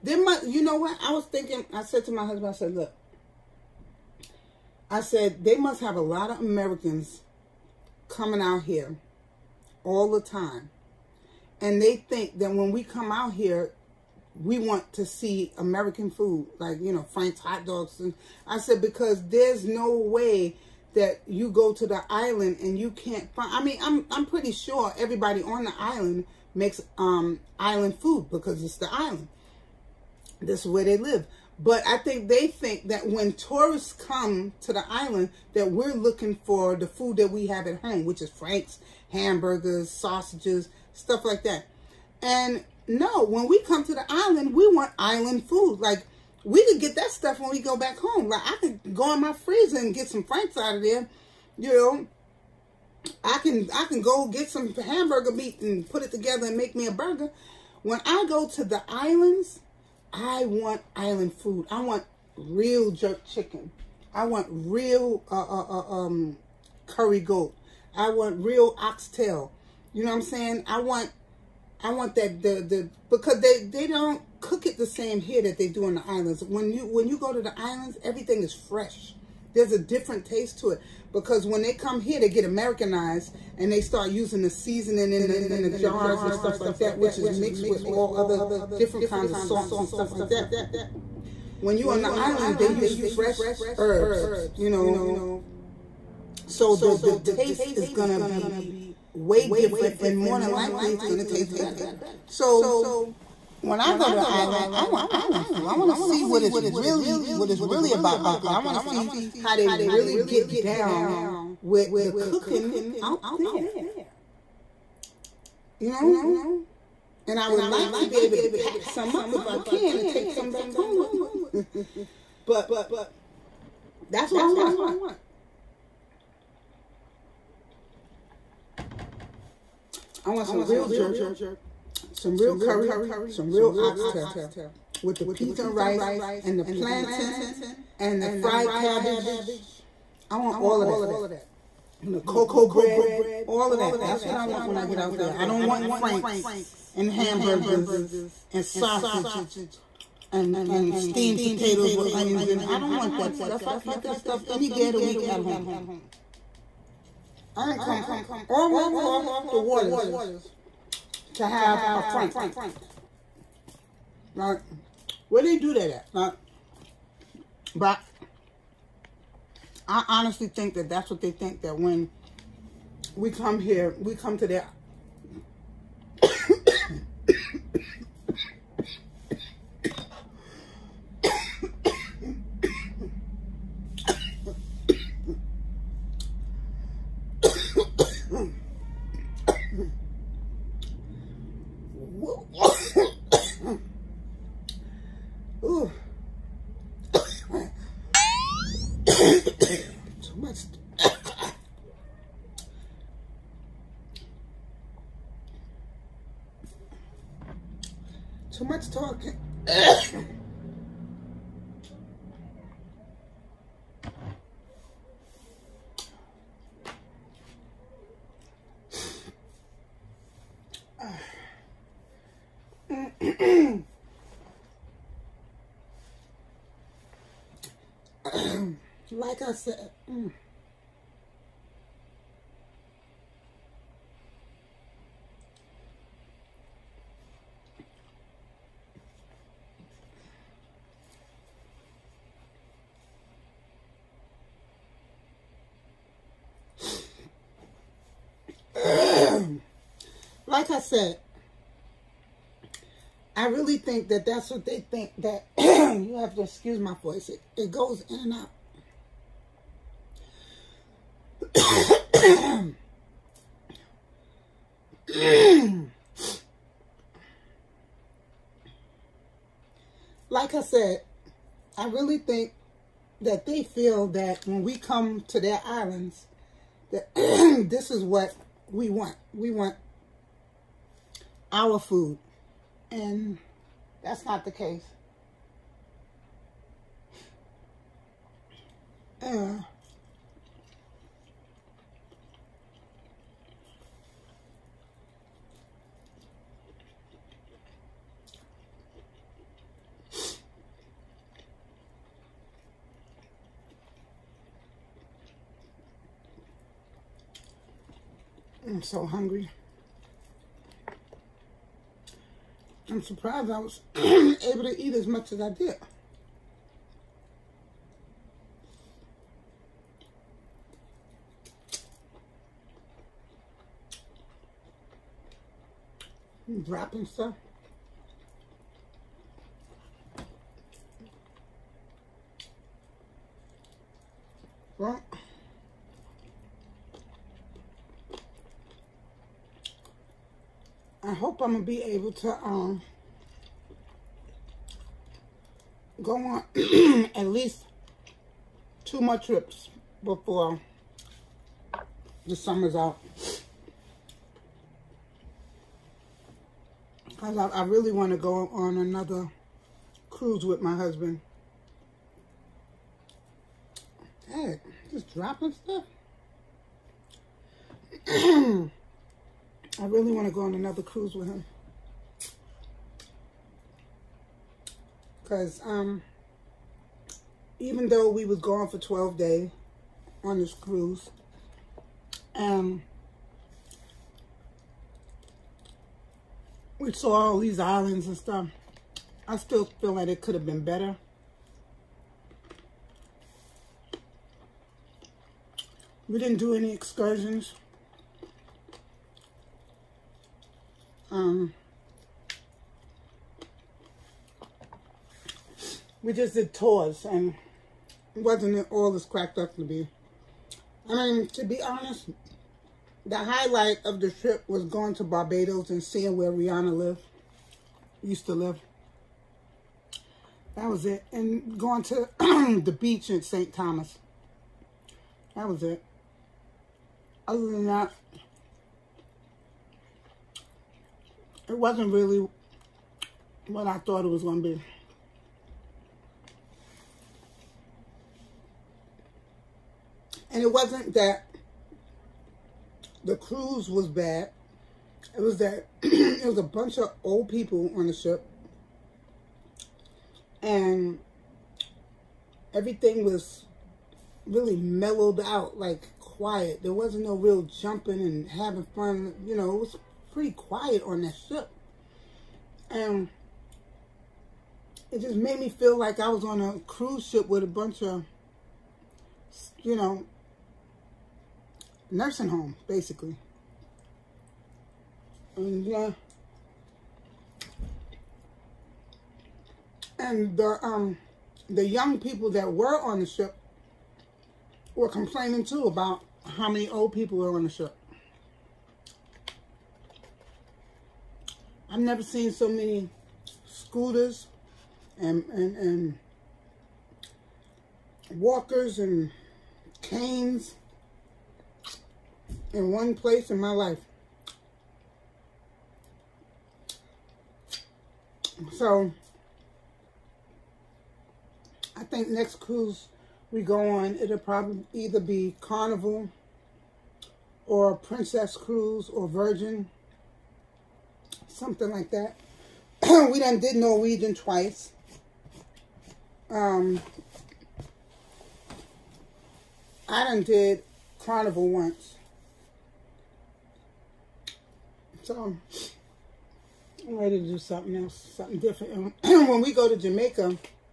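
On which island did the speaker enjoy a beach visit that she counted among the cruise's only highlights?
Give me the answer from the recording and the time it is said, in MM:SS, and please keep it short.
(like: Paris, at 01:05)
St. Thomas, at 07:03.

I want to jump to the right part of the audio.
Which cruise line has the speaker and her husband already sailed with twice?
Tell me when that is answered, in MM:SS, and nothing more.
08:43.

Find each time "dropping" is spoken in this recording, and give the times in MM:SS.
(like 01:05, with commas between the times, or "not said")
05:26, 06:05.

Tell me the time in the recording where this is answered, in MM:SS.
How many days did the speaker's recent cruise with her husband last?
06:18.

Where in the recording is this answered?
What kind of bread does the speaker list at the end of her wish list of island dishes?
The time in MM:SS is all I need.
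02:22.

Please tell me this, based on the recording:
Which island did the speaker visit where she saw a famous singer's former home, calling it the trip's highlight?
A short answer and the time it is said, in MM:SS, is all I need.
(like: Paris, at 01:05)
Barbados, at 06:55.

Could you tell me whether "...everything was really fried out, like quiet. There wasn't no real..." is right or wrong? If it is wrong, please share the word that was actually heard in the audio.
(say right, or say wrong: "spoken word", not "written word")
wrong: "mellowed", not "fried".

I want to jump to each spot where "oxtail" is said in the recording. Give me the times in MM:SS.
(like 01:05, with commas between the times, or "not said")
01:08, 02:13.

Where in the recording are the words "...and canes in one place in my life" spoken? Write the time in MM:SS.
08:18.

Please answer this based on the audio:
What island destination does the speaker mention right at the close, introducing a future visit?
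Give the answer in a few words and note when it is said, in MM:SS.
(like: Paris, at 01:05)
Jamaica, at 08:59.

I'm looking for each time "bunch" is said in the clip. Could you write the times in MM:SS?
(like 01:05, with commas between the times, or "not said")
07:26, 07:47.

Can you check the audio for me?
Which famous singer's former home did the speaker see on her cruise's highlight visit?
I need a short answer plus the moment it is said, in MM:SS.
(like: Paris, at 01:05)
Rihanna, at 06:56.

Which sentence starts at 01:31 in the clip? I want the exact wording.
When you're on the island, they use fresh herbs, you know.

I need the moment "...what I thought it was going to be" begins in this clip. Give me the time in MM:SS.
07:13.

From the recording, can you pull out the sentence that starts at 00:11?
And they think that when we come out here, we want to see American food, like, you know, Frank's hot dogs.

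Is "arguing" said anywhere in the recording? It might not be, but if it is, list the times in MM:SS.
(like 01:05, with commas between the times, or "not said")
not said.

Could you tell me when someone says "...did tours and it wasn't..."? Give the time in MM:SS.
06:46.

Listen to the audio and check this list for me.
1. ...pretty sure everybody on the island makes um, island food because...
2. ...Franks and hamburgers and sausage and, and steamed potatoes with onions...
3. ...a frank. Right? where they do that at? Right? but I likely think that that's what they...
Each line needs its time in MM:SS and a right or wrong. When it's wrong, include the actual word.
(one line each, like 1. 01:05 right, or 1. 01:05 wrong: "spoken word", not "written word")
1. 00:24 right
2. 02:25 right
3. 02:41 wrong: "honestly", not "likely".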